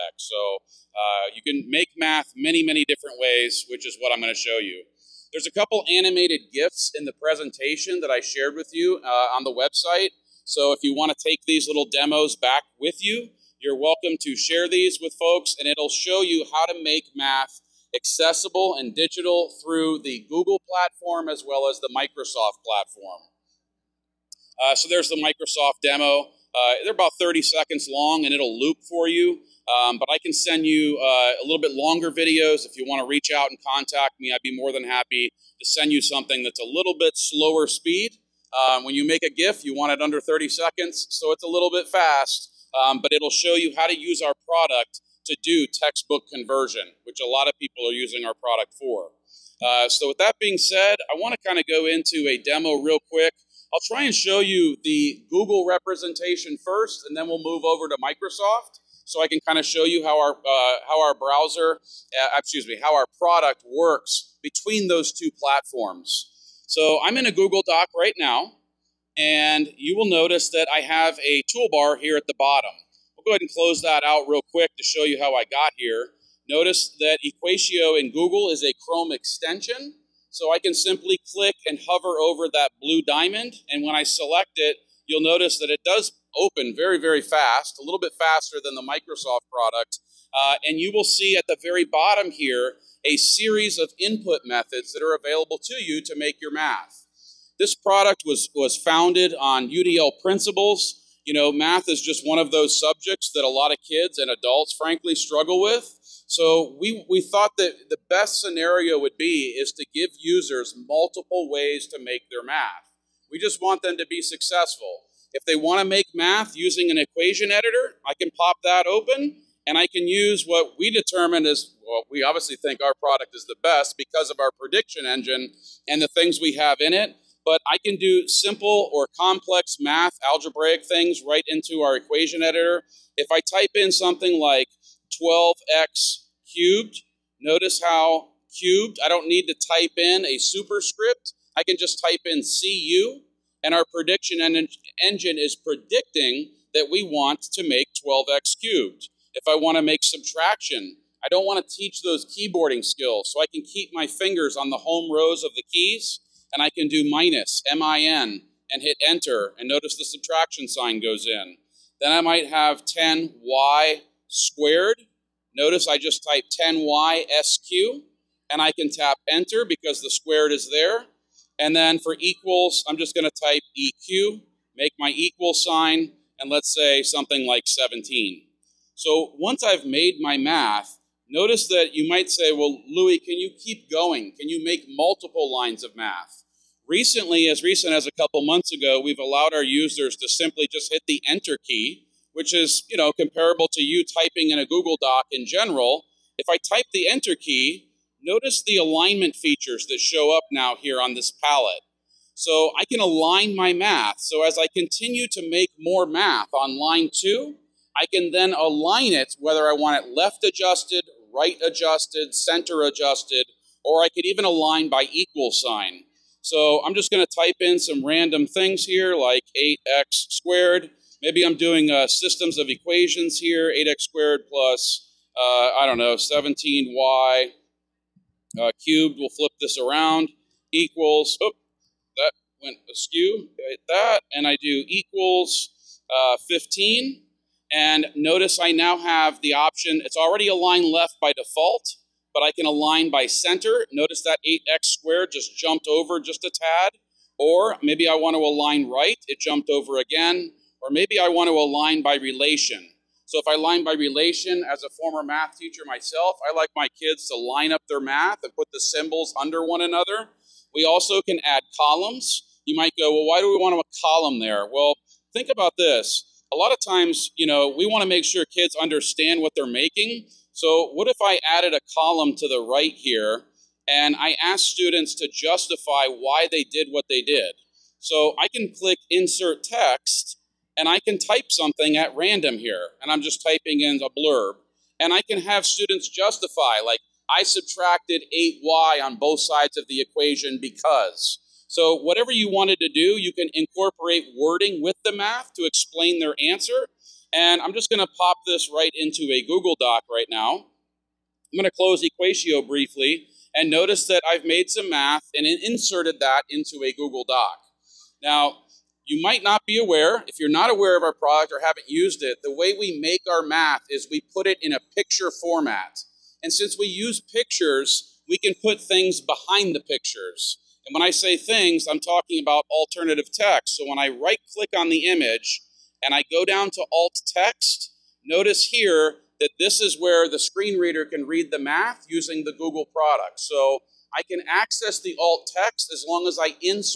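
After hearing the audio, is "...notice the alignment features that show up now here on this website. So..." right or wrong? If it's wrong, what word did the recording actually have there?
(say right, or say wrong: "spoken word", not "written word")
wrong: "palette", not "website".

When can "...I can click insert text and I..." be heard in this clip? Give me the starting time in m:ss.
4:38.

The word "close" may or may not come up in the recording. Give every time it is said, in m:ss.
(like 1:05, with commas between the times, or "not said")
1:13, 5:01.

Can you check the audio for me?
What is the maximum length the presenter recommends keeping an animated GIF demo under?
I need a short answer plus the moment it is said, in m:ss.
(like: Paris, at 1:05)
30 seconds, at 0:40.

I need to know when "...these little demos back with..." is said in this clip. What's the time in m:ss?
0:11.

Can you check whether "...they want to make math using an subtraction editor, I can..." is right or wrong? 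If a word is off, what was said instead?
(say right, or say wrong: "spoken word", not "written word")
wrong: "equation", not "subtraction".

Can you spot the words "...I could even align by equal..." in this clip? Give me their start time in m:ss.
3:34.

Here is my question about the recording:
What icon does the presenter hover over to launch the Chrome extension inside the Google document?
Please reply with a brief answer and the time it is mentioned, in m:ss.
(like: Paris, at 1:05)
blue diamond, at 1:22.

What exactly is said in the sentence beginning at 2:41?
Then I might have 10y squared.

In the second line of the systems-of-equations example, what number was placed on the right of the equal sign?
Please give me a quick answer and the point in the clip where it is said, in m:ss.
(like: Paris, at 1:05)
15, at 3:56.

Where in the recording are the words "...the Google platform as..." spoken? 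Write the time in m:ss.
0:20.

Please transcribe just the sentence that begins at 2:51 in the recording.
And then for equals, I'm just going to type eq, make my equal sign, and let's say something like 17.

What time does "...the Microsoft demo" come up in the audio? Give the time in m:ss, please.
0:25.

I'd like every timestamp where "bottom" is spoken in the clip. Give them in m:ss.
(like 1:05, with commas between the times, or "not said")
1:12, 1:31.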